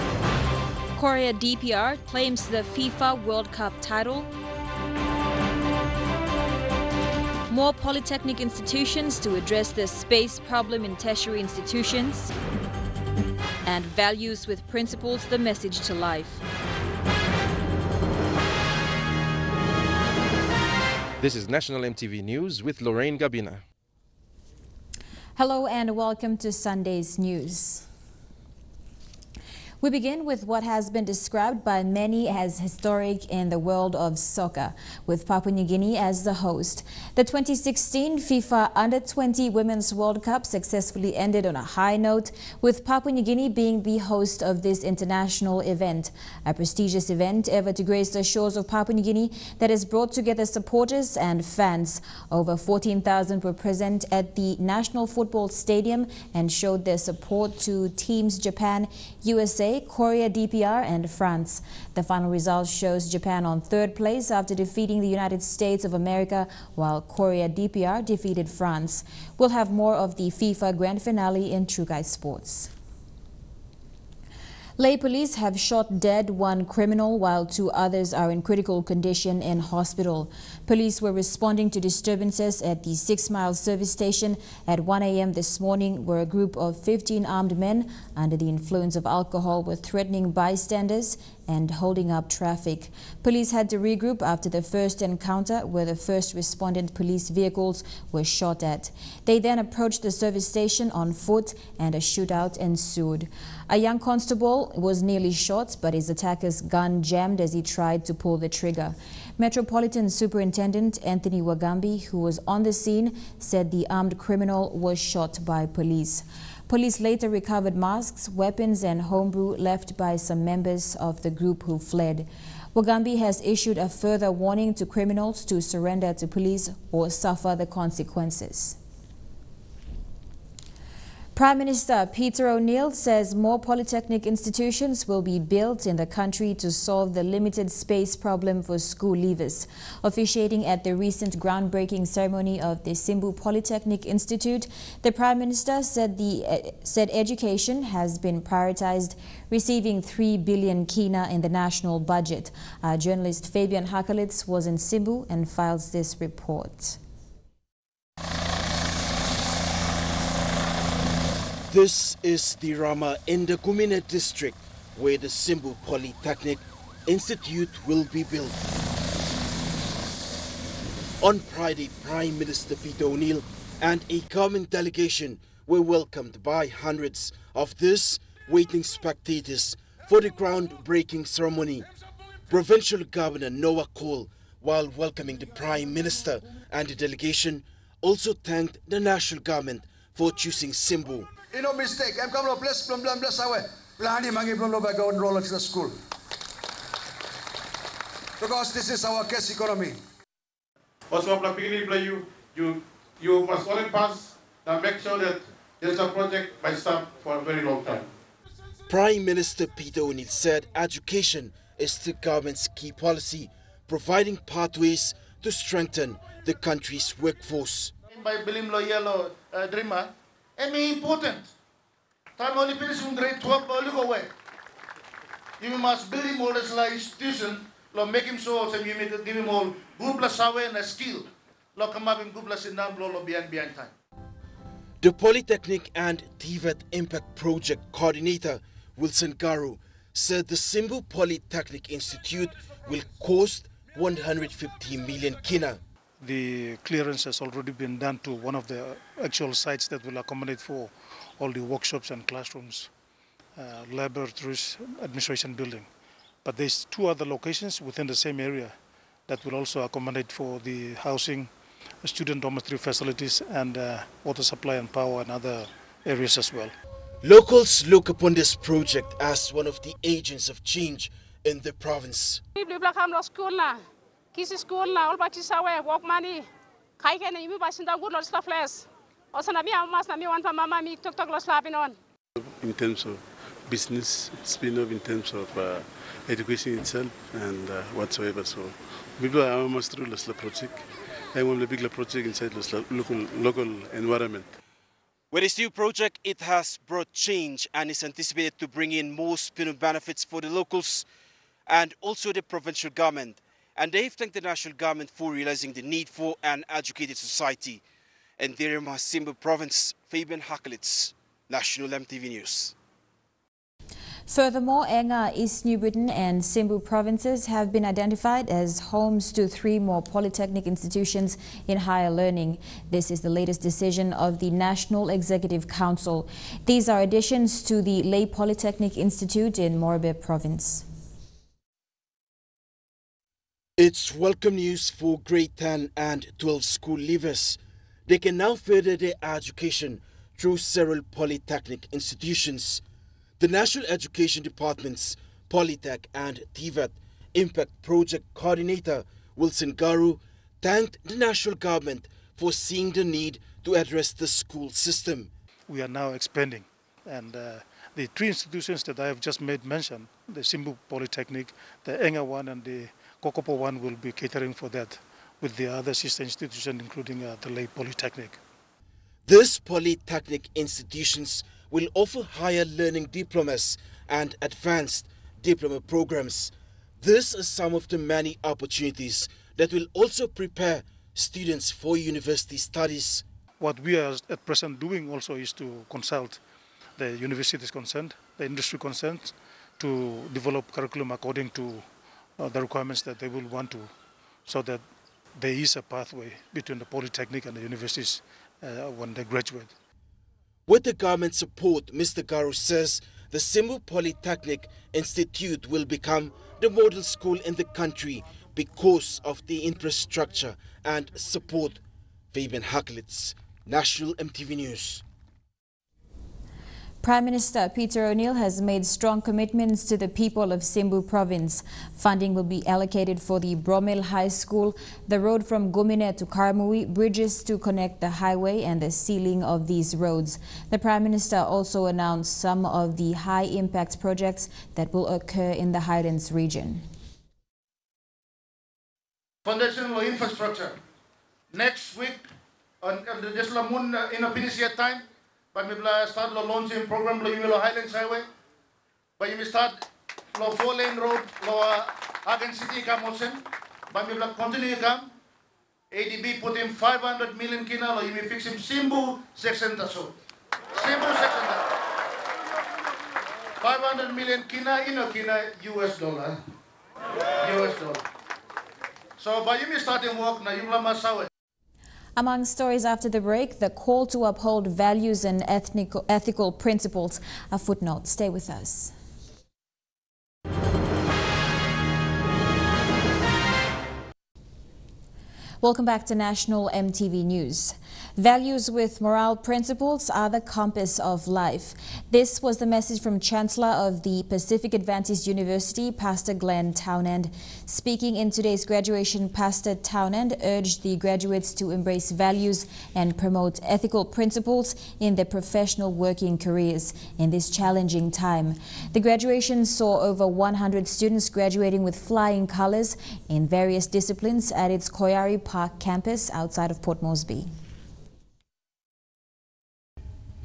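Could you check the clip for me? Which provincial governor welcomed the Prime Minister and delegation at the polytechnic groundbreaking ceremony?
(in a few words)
Noah Kool.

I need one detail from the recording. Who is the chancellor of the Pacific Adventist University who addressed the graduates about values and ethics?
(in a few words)
Glenn Townend.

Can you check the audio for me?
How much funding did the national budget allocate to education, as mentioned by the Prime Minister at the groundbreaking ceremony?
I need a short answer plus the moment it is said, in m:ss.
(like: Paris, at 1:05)
3 billion kina, at 2:30.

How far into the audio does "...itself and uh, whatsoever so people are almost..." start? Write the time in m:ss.
4:46.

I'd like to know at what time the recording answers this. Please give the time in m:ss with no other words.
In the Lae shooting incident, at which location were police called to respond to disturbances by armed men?
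1:22.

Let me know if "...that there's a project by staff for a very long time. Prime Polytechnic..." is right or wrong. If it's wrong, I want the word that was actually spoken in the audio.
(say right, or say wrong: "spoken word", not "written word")
wrong: "Minister", not "Polytechnic".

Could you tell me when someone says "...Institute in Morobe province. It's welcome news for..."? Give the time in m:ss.
5:28.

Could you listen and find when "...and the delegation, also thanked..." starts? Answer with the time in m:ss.
3:06.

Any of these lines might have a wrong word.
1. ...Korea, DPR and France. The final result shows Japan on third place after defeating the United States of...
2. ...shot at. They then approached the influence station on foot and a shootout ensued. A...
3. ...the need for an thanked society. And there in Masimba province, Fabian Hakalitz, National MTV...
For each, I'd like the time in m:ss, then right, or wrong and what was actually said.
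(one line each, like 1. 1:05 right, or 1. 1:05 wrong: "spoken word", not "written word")
1. 0:59 right
2. 1:38 wrong: "service", not "influence"
3. 5:05 wrong: "educated", not "thanked".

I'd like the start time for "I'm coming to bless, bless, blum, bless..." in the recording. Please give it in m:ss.
3:12.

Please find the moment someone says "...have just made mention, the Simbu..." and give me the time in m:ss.
5:59.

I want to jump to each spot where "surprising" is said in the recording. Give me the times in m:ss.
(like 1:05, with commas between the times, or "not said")
not said.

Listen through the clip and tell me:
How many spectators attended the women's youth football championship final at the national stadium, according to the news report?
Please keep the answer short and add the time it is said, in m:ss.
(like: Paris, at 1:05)
Over 14,000, at 0:52.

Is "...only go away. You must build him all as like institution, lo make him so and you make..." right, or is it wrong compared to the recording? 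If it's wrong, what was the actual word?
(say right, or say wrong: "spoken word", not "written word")
right.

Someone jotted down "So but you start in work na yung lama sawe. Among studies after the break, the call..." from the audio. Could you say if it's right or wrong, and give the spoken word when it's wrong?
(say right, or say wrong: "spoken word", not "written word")
wrong: "stories", not "studies".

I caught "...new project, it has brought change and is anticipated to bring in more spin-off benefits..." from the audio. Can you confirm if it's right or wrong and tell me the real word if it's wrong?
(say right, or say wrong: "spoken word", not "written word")
right.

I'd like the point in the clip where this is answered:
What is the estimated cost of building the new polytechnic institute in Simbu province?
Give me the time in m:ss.
4:03.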